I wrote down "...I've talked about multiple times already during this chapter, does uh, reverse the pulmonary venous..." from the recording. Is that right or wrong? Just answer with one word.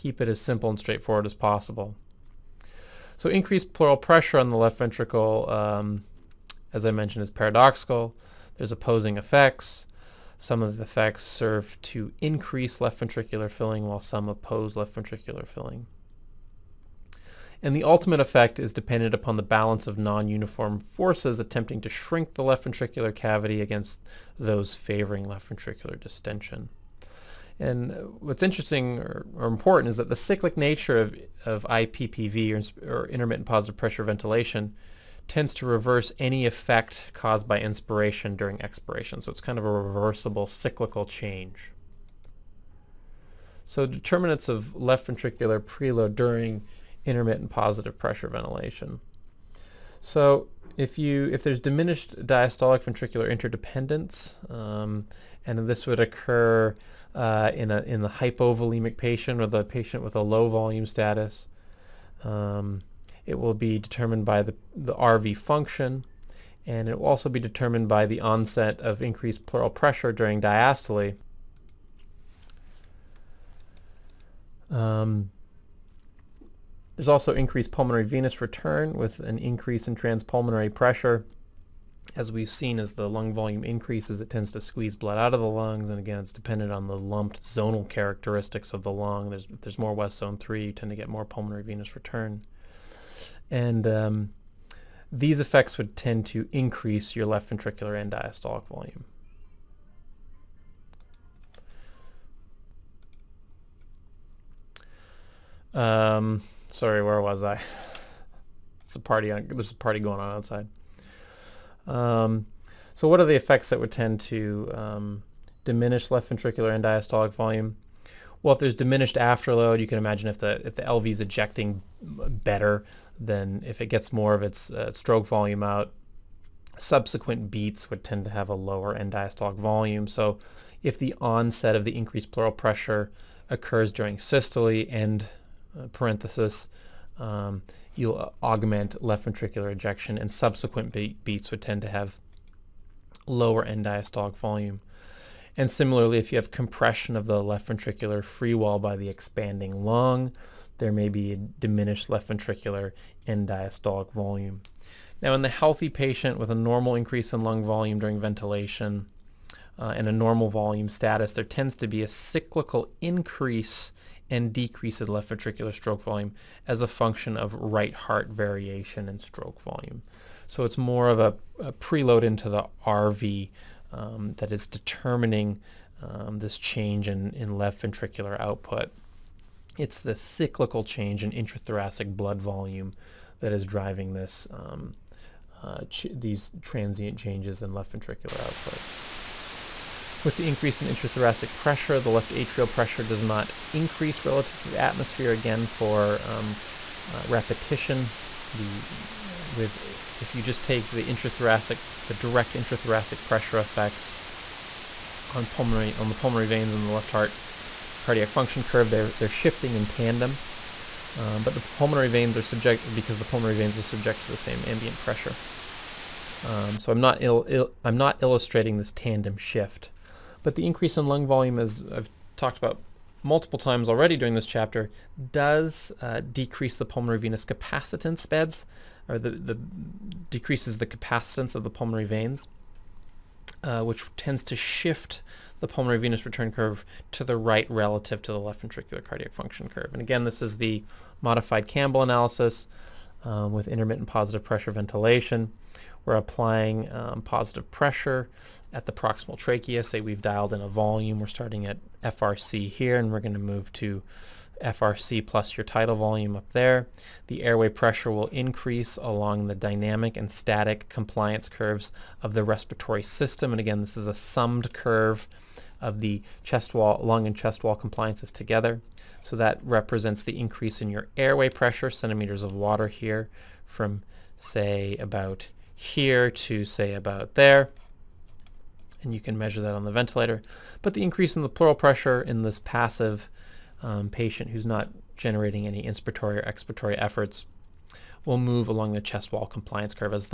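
wrong.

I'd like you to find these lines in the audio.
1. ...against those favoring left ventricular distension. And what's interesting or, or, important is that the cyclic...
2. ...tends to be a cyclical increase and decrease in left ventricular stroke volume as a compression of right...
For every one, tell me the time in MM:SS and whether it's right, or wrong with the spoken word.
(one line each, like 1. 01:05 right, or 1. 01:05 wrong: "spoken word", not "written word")
1. 00:23 right
2. 02:41 wrong: "function", not "compression".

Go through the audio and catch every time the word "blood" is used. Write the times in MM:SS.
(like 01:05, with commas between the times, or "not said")
01:24, 03:02.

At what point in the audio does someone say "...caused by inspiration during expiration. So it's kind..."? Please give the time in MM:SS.
00:37.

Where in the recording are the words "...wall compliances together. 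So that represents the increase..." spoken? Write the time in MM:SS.
04:27.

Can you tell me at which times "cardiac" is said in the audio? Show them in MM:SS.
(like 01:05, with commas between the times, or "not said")
03:28, 03:59.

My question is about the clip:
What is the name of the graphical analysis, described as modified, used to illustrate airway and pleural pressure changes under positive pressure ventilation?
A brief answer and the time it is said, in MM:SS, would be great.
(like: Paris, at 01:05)
Campbell analysis, at 04:01.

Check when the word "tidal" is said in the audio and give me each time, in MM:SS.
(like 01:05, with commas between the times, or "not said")
04:15.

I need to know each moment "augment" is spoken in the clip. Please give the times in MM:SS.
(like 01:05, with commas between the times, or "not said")
02:18.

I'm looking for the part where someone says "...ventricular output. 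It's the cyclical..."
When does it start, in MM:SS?
02:57.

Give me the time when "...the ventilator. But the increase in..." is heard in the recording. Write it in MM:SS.
04:39.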